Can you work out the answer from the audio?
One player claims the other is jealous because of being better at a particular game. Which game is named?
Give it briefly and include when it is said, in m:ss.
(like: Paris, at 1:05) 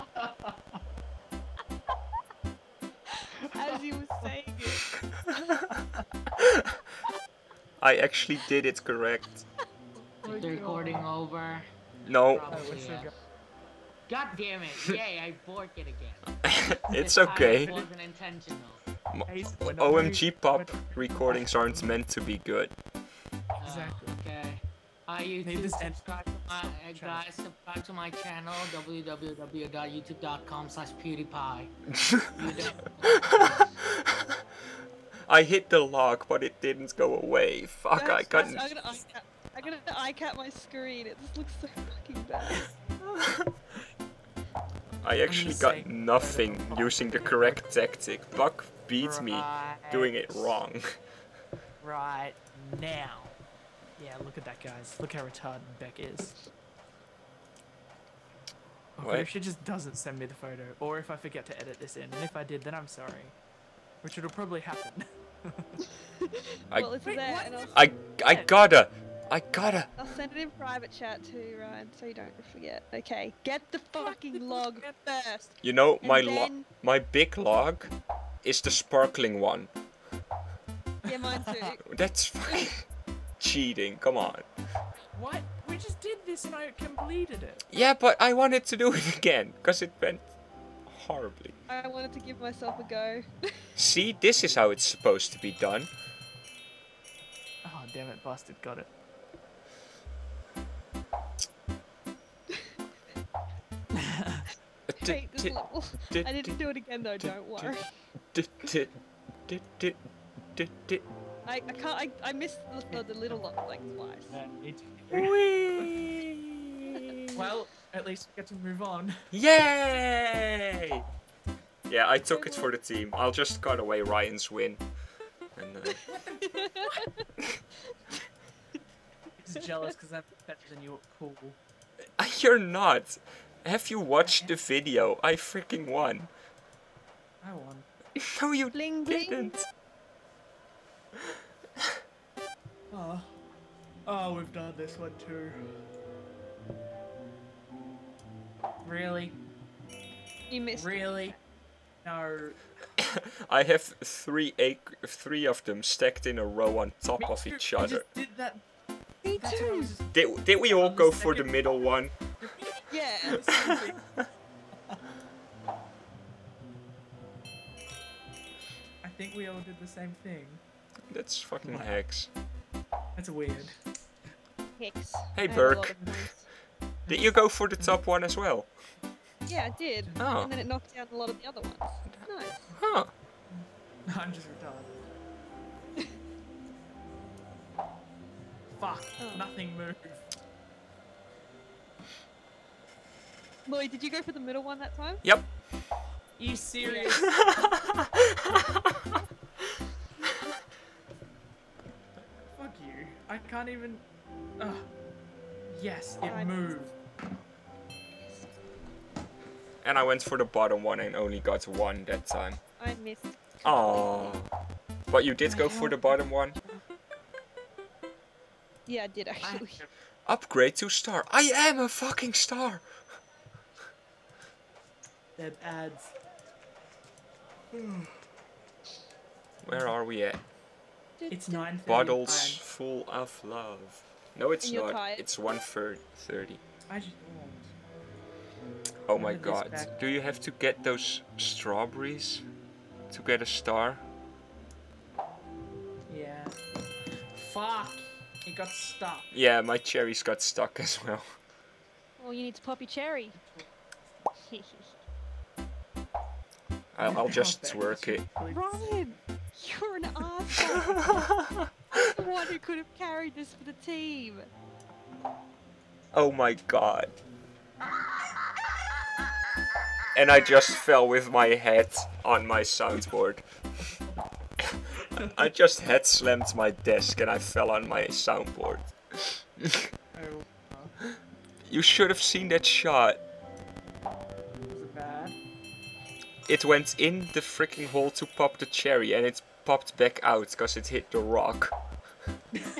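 pool, at 2:11.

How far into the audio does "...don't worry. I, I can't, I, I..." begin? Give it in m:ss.
1:47.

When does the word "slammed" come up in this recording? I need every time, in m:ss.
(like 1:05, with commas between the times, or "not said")
4:36.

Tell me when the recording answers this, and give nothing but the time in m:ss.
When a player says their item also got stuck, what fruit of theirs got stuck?
4:09.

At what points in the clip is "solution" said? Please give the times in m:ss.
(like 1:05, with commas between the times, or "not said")
not said.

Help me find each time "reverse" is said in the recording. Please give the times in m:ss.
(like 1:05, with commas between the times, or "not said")
not said.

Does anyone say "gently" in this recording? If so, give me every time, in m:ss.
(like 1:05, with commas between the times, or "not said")
not said.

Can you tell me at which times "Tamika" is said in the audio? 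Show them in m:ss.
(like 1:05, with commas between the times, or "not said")
not said.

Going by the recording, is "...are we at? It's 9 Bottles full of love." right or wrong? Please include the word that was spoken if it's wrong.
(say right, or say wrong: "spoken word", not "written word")
right.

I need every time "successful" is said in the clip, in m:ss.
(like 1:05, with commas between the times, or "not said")
not said.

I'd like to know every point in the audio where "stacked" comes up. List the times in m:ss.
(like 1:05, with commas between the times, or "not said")
2:35.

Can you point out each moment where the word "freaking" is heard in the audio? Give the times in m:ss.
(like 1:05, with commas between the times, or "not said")
2:15, 4:47.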